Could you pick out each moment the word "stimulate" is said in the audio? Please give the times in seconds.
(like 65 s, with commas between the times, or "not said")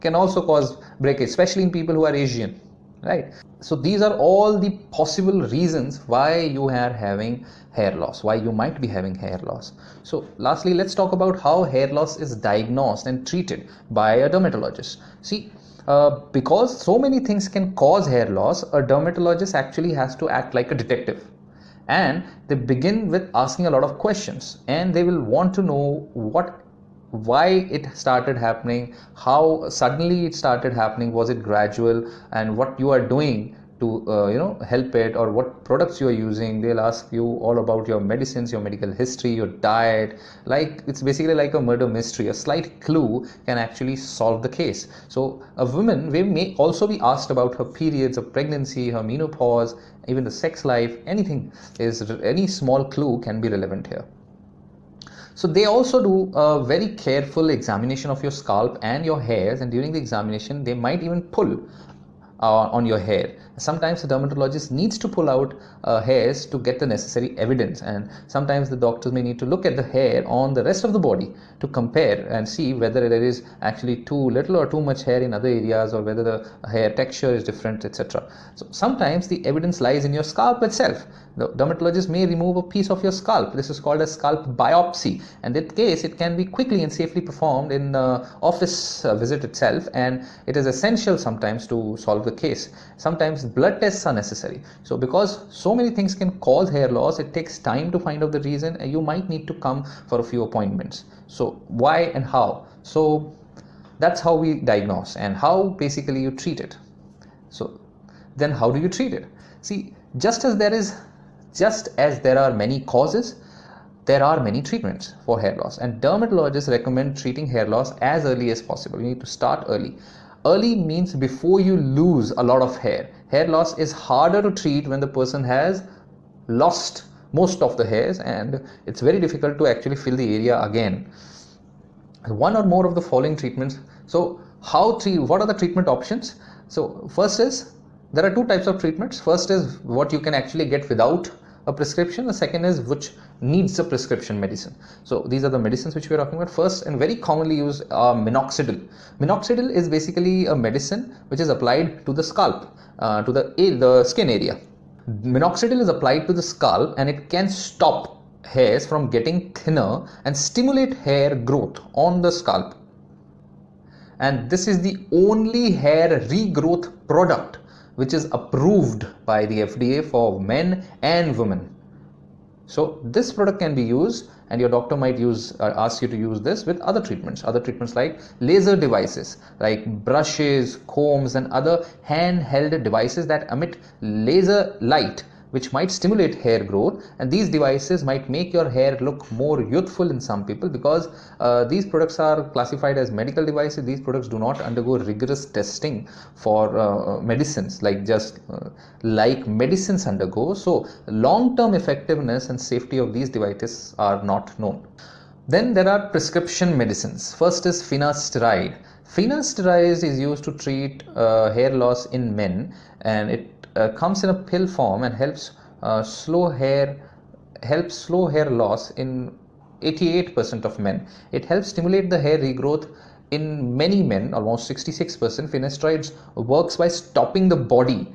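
160 s, 185 s, 221 s.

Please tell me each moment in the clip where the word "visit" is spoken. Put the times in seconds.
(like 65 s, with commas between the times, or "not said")
89 s.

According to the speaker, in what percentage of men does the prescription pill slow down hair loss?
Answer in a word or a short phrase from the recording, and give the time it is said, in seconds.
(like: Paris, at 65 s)
88%, at 219 s.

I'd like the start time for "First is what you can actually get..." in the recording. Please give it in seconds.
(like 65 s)
139 s.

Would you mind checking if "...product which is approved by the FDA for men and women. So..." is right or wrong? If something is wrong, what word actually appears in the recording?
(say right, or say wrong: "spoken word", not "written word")
right.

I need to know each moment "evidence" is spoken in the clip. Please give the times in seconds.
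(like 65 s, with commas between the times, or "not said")
67 s, 79 s.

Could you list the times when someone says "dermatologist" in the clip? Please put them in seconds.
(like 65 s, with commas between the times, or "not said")
14 s, 18 s, 64 s, 81 s, 116 s.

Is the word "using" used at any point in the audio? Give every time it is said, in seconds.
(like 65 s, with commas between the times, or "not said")
36 s.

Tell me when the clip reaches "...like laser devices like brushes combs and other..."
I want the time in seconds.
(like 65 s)
177 s.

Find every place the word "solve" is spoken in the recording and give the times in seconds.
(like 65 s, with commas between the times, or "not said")
43 s, 91 s.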